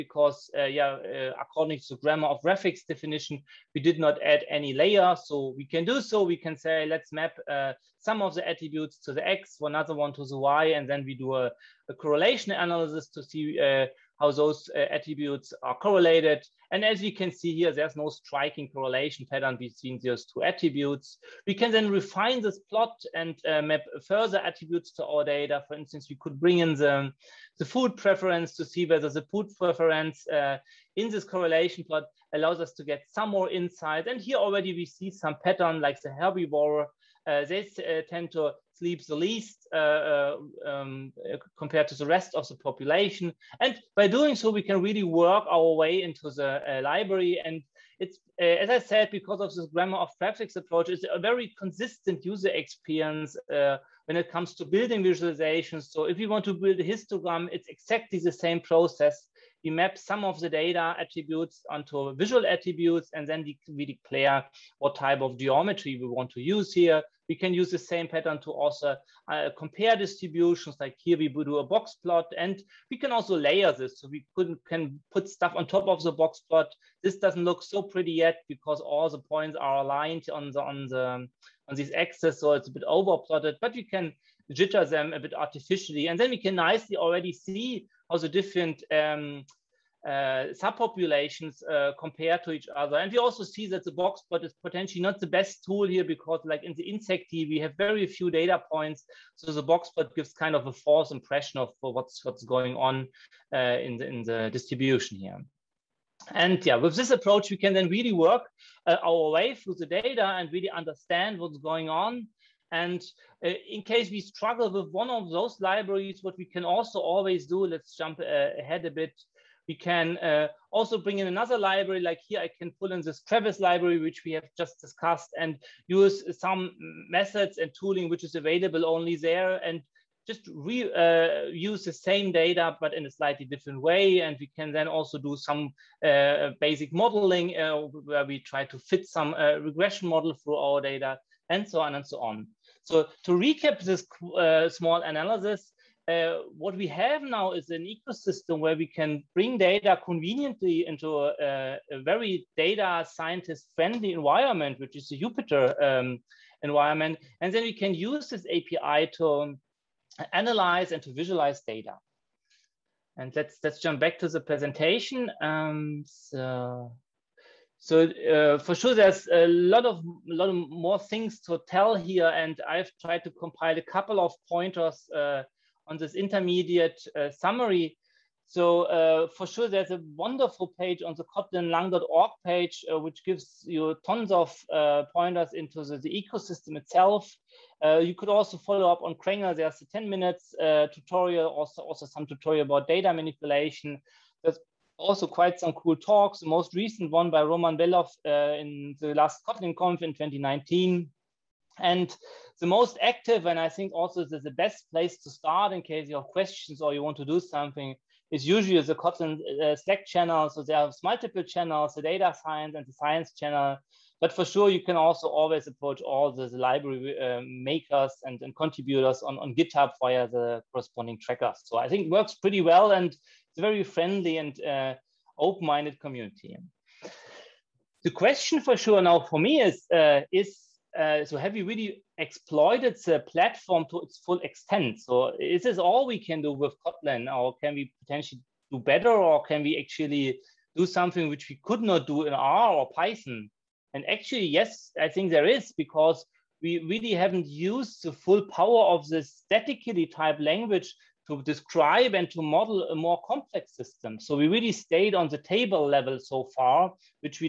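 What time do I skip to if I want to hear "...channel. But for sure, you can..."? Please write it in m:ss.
3:33.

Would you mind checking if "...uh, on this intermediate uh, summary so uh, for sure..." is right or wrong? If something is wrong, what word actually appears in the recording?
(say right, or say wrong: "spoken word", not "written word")
right.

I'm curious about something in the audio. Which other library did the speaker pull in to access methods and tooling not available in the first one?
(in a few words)
kravis.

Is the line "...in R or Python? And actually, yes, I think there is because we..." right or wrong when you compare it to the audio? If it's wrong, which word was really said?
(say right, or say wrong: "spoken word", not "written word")
right.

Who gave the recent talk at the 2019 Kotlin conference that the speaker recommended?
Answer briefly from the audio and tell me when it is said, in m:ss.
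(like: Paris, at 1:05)
Roman Belov, at 3:17.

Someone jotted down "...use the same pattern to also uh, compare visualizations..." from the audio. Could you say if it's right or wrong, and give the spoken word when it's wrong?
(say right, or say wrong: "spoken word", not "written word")
wrong: "distributions", not "visualizations".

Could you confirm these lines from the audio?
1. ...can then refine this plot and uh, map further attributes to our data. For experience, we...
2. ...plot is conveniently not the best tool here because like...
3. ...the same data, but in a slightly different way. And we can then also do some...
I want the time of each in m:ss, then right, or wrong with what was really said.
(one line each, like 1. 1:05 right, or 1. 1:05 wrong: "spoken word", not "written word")
1. 0:21 wrong: "instance", not "experience"
2. 1:34 wrong: "potentially", not "conveniently"
3. 2:11 right.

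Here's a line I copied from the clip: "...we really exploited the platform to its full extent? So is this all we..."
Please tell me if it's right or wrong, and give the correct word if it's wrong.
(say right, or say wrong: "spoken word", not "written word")
right.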